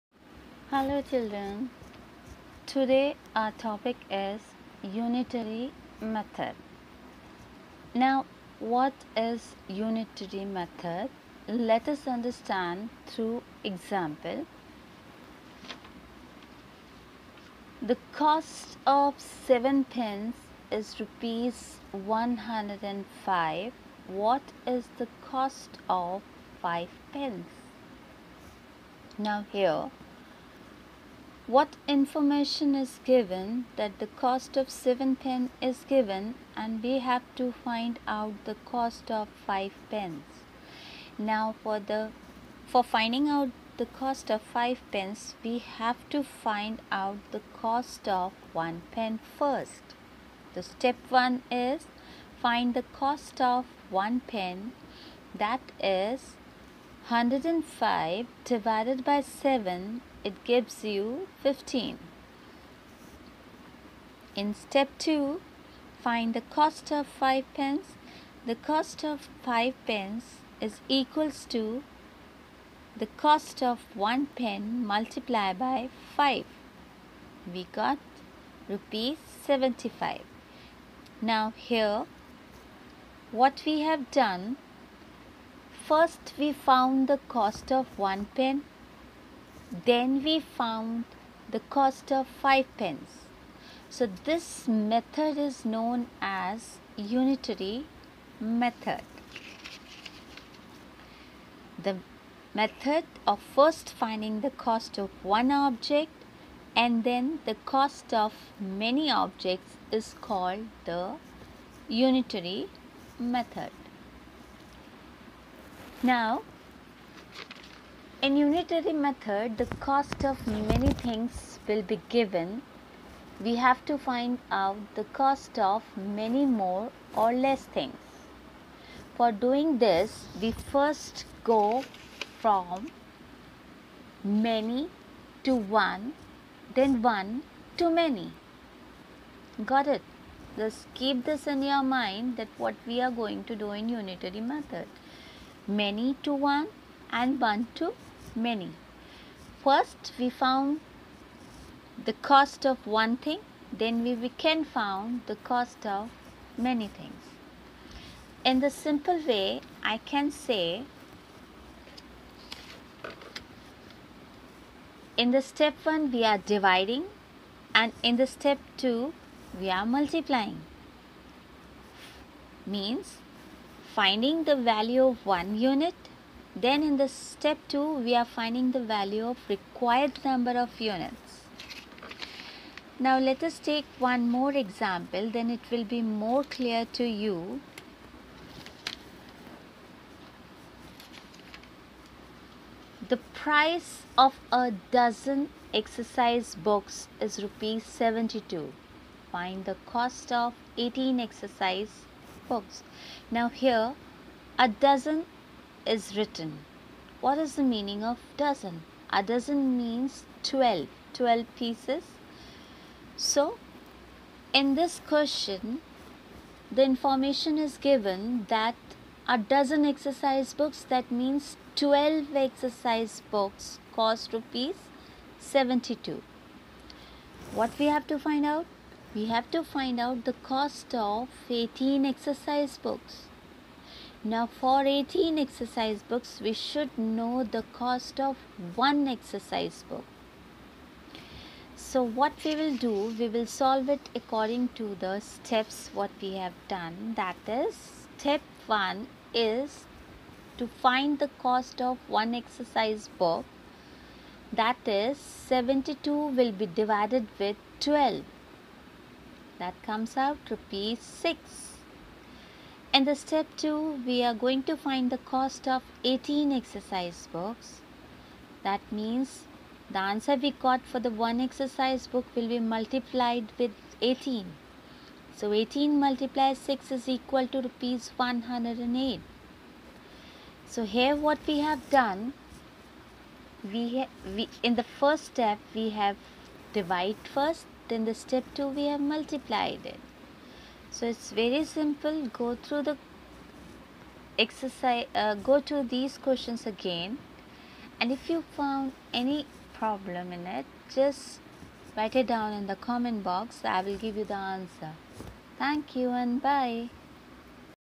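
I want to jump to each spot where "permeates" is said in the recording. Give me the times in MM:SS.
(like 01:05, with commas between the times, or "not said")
not said.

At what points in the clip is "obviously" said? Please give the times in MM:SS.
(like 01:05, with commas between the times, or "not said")
not said.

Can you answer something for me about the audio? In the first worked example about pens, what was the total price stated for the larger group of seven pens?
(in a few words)
Rs 105.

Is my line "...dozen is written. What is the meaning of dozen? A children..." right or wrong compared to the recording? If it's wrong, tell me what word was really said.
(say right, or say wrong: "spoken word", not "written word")
wrong: "dozen", not "children".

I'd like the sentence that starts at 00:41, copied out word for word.
Now for the for finding out the cost of 5 pens we have to find out the cost of 1 pen first.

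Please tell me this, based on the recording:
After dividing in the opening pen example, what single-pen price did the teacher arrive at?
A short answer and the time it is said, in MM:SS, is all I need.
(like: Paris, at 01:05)
15, at 01:01.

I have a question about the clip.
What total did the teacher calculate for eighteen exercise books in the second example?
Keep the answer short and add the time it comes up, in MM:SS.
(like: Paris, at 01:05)
Rs 108, at 04:37.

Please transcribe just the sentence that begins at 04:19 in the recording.
That comes out rupees 6 in the step 2, we are going to find the cost of 18 exercise books.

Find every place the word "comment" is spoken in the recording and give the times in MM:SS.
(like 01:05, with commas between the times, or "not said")
05:02.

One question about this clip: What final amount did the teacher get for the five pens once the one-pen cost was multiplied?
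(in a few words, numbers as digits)
Rs 75.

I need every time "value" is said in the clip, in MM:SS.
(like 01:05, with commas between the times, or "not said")
02:54, 02:58.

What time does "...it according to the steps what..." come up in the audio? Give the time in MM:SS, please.
04:03.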